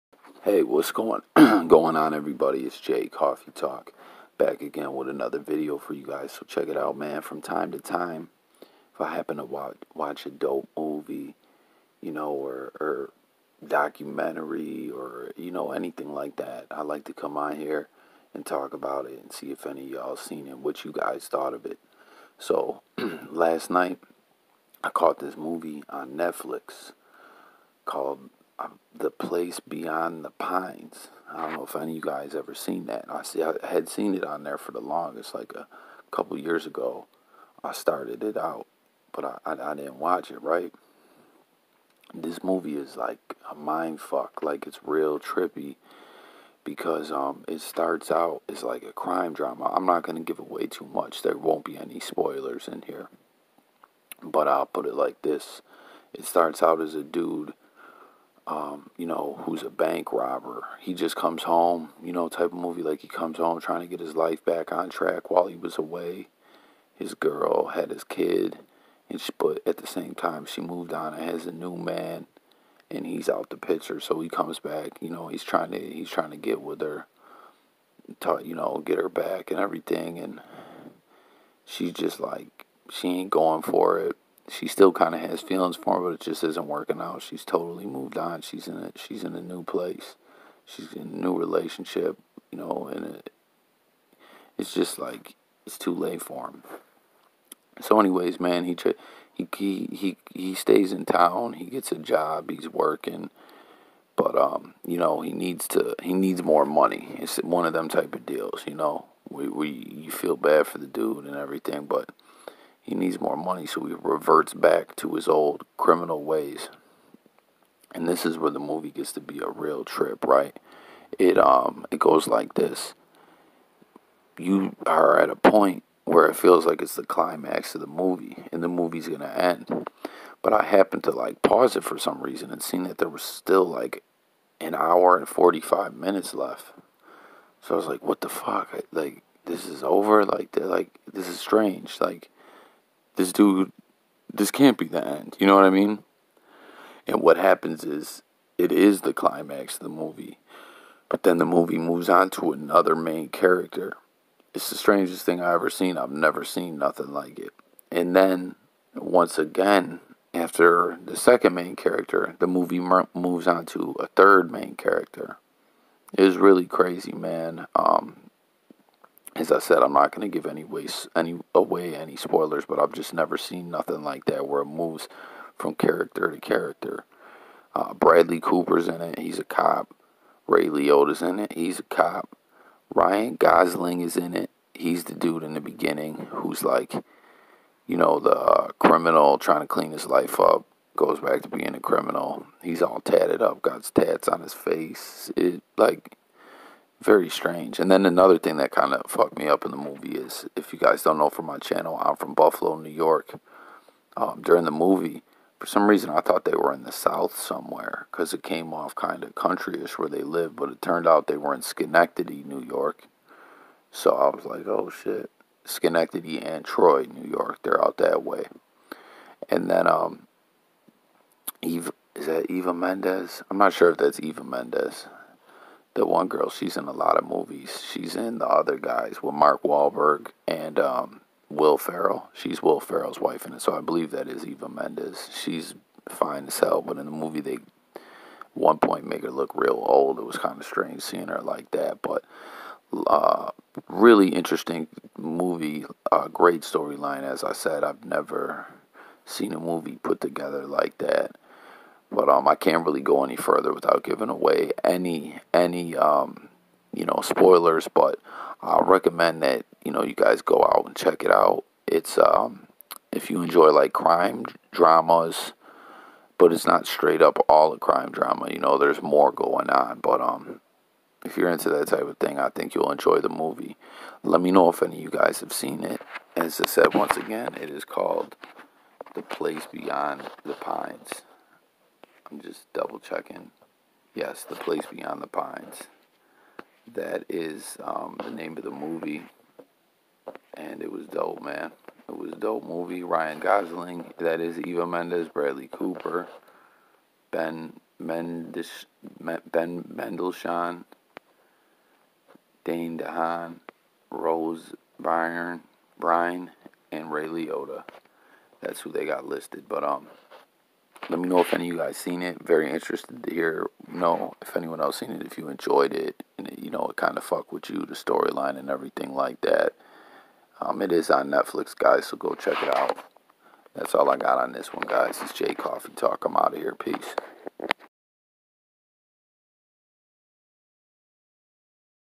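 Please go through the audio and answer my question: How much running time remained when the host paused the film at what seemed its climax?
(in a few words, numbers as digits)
1 hour 45 minutes.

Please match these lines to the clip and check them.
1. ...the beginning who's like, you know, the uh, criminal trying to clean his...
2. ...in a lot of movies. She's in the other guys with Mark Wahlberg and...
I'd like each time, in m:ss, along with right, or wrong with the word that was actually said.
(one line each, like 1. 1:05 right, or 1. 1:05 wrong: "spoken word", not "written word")
1. 3:05 right
2. 3:46 right.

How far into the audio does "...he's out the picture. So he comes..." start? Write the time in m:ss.
1:13.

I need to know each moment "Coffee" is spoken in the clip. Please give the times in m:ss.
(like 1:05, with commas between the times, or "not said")
0:03, 5:25.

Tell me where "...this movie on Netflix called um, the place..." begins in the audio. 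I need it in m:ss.
0:25.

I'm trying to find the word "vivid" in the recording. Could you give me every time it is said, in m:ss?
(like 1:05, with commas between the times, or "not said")
not said.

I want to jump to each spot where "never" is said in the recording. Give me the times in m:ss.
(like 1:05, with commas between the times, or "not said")
2:36, 2:53, 4:08.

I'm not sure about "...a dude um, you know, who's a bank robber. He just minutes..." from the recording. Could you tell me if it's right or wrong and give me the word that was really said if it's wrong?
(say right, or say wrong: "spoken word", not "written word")
wrong: "comes", not "minutes".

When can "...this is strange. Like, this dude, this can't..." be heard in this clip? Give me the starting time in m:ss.
2:21.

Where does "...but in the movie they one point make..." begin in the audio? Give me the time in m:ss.
3:56.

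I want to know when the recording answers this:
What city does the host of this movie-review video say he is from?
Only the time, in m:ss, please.
3:22.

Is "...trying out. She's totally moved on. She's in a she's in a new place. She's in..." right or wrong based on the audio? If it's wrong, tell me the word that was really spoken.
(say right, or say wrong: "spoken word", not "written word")
wrong: "working", not "trying".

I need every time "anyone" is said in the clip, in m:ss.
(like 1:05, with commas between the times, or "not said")
5:14.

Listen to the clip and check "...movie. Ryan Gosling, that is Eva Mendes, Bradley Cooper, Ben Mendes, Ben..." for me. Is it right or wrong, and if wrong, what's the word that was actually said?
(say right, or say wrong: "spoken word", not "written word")
right.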